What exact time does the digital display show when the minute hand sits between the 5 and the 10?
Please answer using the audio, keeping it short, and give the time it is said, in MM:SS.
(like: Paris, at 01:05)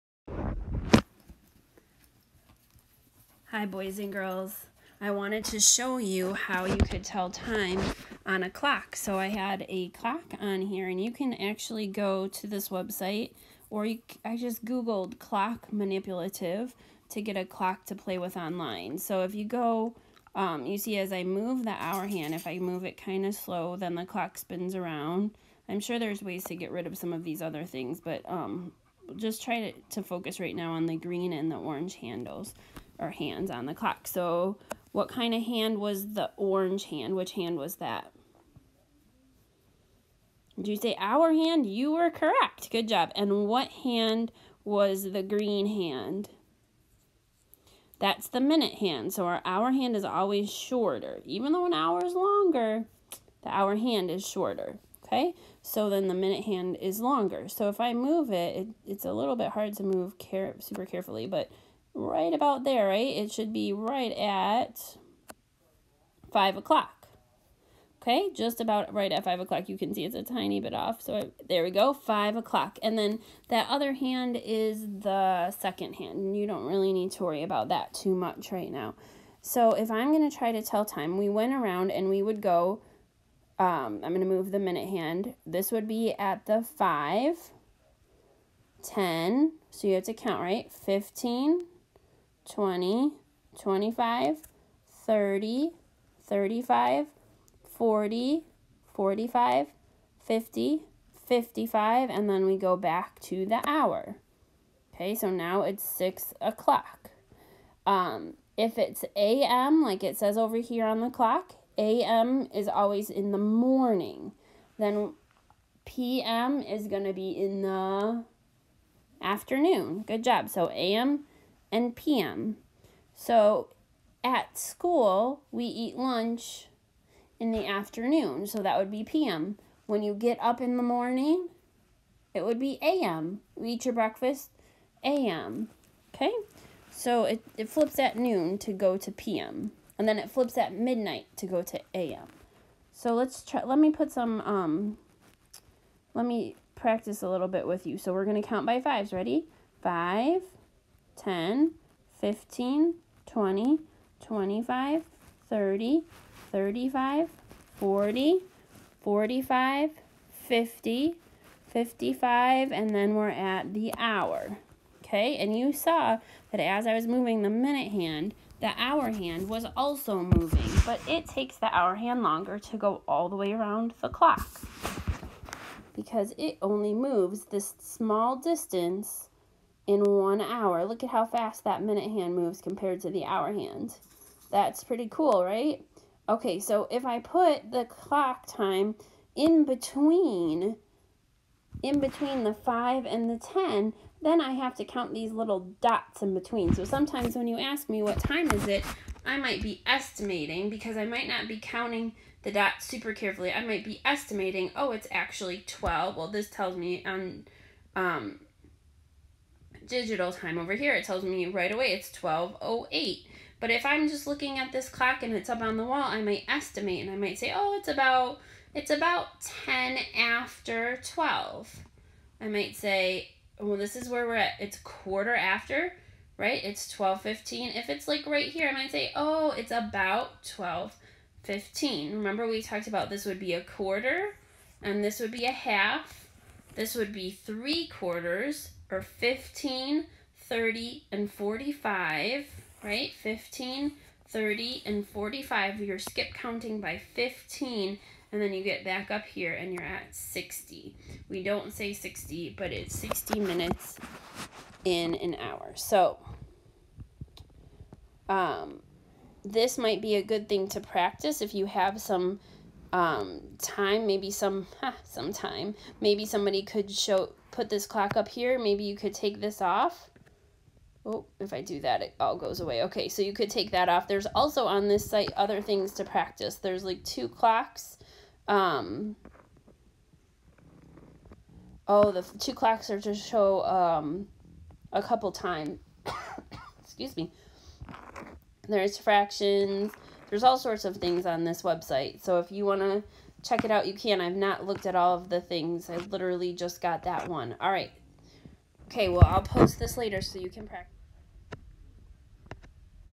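12.08, at 03:32.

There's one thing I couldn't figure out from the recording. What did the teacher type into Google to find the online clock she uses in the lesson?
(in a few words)
clock manipulative.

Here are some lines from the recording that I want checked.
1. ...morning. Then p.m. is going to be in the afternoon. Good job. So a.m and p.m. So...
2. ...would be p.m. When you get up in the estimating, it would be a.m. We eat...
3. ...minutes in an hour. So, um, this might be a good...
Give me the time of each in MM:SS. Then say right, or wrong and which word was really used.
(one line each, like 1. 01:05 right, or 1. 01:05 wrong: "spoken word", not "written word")
1. 01:53 right
2. 02:08 wrong: "morning", not "estimating"
3. 04:13 right.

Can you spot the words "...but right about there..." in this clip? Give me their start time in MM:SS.
01:01.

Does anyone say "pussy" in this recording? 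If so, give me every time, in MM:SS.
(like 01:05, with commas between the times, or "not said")
not said.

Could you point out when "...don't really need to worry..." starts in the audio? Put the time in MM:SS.
01:16.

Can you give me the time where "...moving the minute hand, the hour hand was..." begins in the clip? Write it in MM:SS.
02:47.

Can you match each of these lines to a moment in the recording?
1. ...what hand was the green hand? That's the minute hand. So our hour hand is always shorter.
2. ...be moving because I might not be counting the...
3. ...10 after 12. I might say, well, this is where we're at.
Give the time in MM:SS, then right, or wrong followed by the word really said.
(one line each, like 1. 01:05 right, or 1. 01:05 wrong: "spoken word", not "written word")
1. 00:43 right
2. 03:19 wrong: "estimating", not "moving"
3. 03:39 right.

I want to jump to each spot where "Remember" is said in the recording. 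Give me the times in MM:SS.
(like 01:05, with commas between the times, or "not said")
03:52.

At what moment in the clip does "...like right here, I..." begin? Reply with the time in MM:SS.
03:48.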